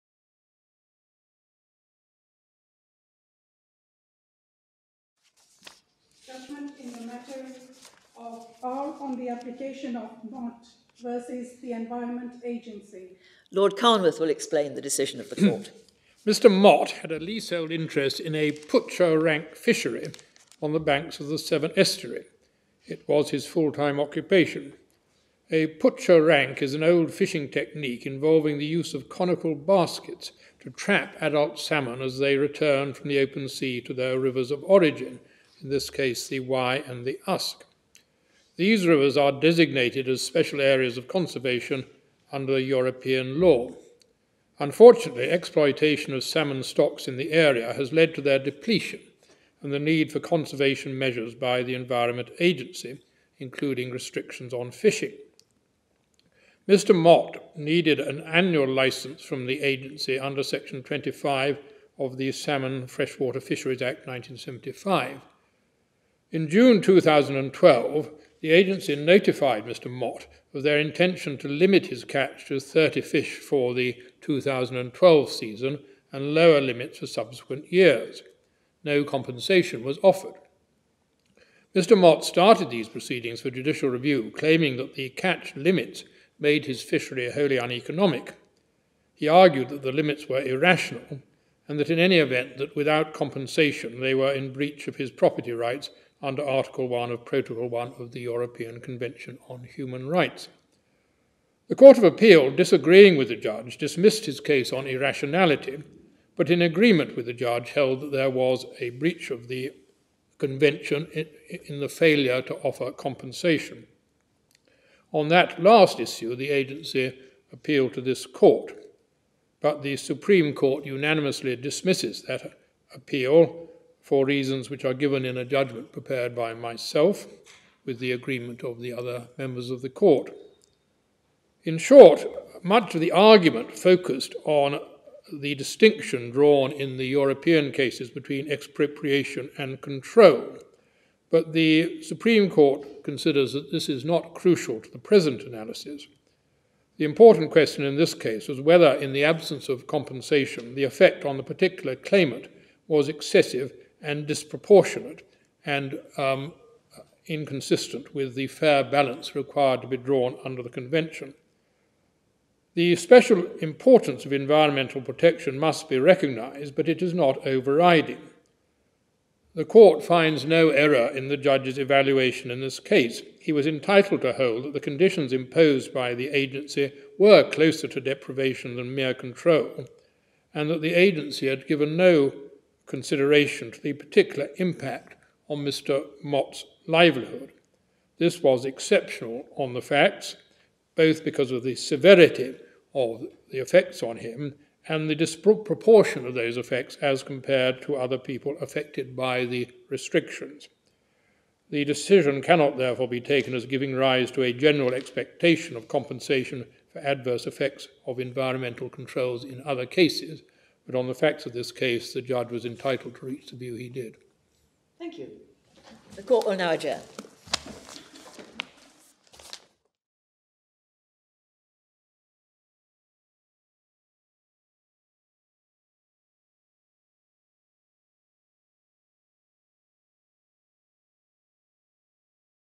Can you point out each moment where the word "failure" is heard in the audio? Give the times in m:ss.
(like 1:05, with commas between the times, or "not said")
1:51.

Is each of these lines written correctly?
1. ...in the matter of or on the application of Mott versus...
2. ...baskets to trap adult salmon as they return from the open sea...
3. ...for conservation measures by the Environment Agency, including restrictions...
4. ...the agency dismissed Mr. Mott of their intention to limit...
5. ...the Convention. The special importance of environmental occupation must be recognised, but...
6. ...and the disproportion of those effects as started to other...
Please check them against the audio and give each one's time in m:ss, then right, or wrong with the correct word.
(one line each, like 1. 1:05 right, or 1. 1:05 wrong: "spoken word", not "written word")
1. 0:06 right
2. 0:29 right
3. 0:50 right
4. 1:08 wrong: "notified", not "dismissed"
5. 2:40 wrong: "protection", not "occupation"
6. 3:14 wrong: "compared", not "started".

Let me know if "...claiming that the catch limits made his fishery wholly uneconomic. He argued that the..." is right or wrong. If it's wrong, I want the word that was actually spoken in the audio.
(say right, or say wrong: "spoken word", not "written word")
right.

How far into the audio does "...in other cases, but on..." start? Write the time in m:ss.
3:29.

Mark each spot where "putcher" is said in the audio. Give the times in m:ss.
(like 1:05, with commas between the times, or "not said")
0:18, 0:25.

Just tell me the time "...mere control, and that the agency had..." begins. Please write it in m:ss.
2:58.